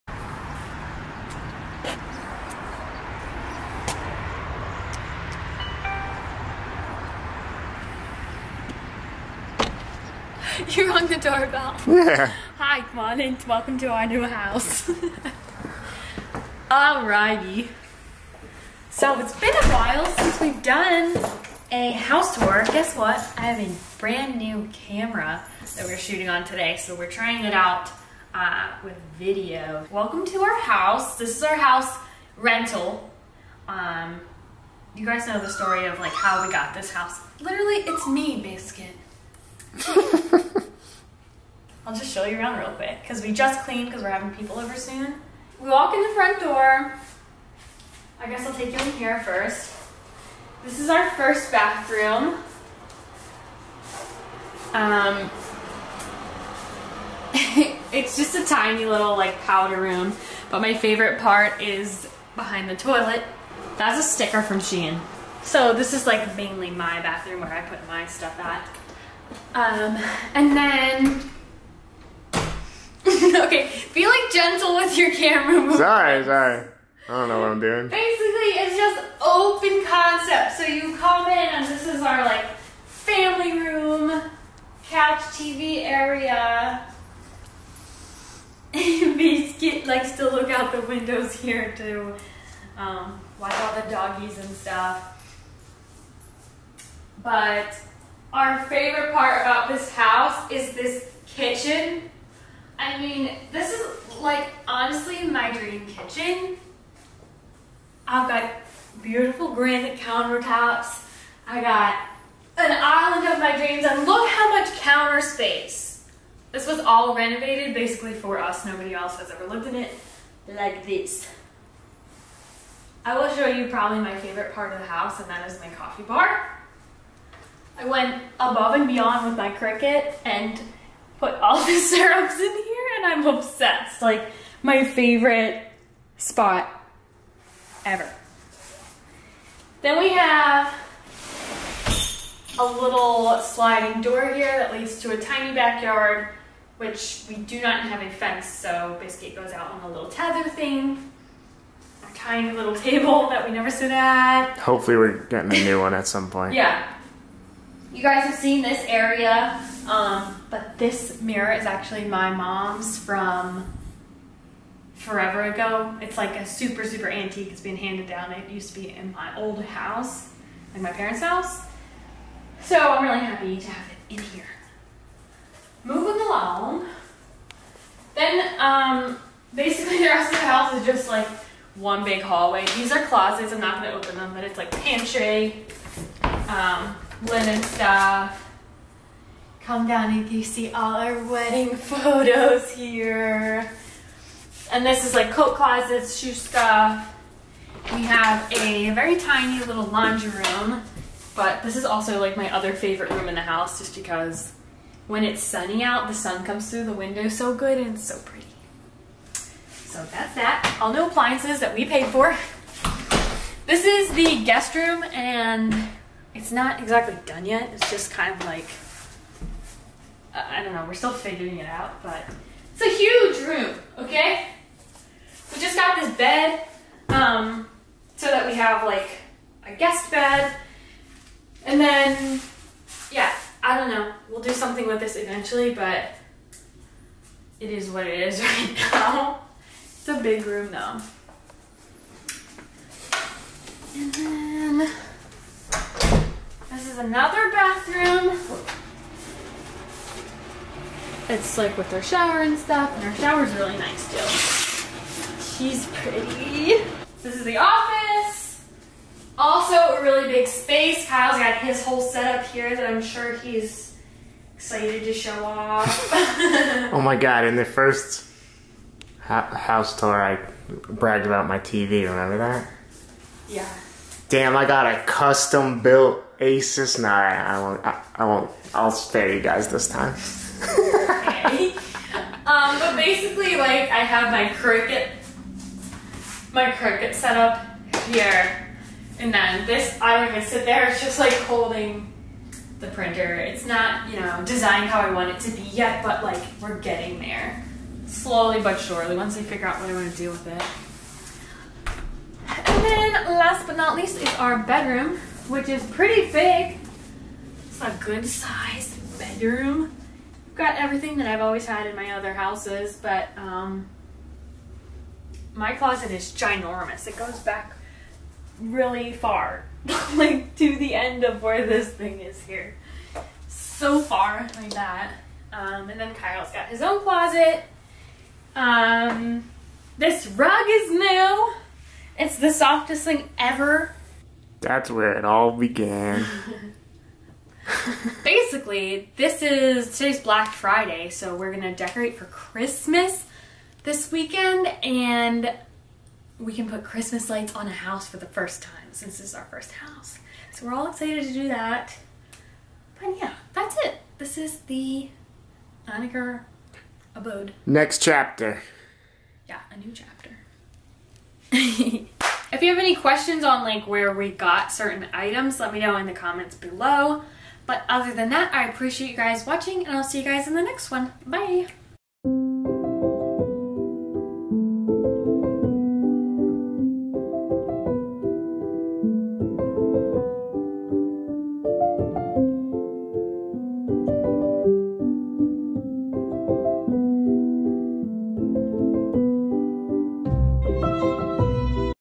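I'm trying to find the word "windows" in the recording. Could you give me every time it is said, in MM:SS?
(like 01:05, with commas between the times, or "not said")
01:30, 03:26.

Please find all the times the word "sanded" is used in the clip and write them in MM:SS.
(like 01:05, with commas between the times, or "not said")
not said.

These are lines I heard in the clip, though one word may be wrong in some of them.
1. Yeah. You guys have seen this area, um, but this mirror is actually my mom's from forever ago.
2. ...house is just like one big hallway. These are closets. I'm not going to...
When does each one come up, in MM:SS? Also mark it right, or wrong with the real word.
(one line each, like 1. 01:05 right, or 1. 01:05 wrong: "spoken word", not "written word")
1. 02:36 right
2. 03:00 right.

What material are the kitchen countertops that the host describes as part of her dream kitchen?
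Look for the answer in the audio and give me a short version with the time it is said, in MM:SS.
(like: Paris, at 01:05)
Granite, at 01:49.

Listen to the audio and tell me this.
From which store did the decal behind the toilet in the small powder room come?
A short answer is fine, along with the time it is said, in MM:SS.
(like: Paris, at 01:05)
Shein, at 01:04.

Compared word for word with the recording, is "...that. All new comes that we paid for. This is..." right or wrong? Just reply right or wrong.
wrong.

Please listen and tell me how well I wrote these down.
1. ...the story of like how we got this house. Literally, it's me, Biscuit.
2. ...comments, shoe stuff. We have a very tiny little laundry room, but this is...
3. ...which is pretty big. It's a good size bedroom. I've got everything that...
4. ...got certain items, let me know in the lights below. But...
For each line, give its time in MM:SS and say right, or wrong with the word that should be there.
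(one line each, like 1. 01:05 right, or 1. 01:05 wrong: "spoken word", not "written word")
1. 00:35 right
2. 03:15 wrong: "closets", not "comments"
3. 05:05 right
4. 06:04 wrong: "comments", not "lights".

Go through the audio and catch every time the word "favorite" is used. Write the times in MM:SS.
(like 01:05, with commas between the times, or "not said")
01:00, 01:38, 02:04, 02:14, 03:22.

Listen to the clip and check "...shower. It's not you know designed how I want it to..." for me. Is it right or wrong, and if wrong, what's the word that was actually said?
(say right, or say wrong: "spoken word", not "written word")
wrong: "printer", not "shower".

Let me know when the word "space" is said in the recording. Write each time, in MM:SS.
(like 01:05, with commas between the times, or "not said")
01:55, 04:20.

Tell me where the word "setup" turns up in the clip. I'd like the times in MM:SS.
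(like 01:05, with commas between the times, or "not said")
04:22.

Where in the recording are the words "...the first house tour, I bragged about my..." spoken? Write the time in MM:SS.
04:27.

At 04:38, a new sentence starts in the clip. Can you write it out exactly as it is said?
I'll spare you guys this time.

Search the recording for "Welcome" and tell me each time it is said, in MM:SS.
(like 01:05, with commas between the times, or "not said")
00:13, 00:29.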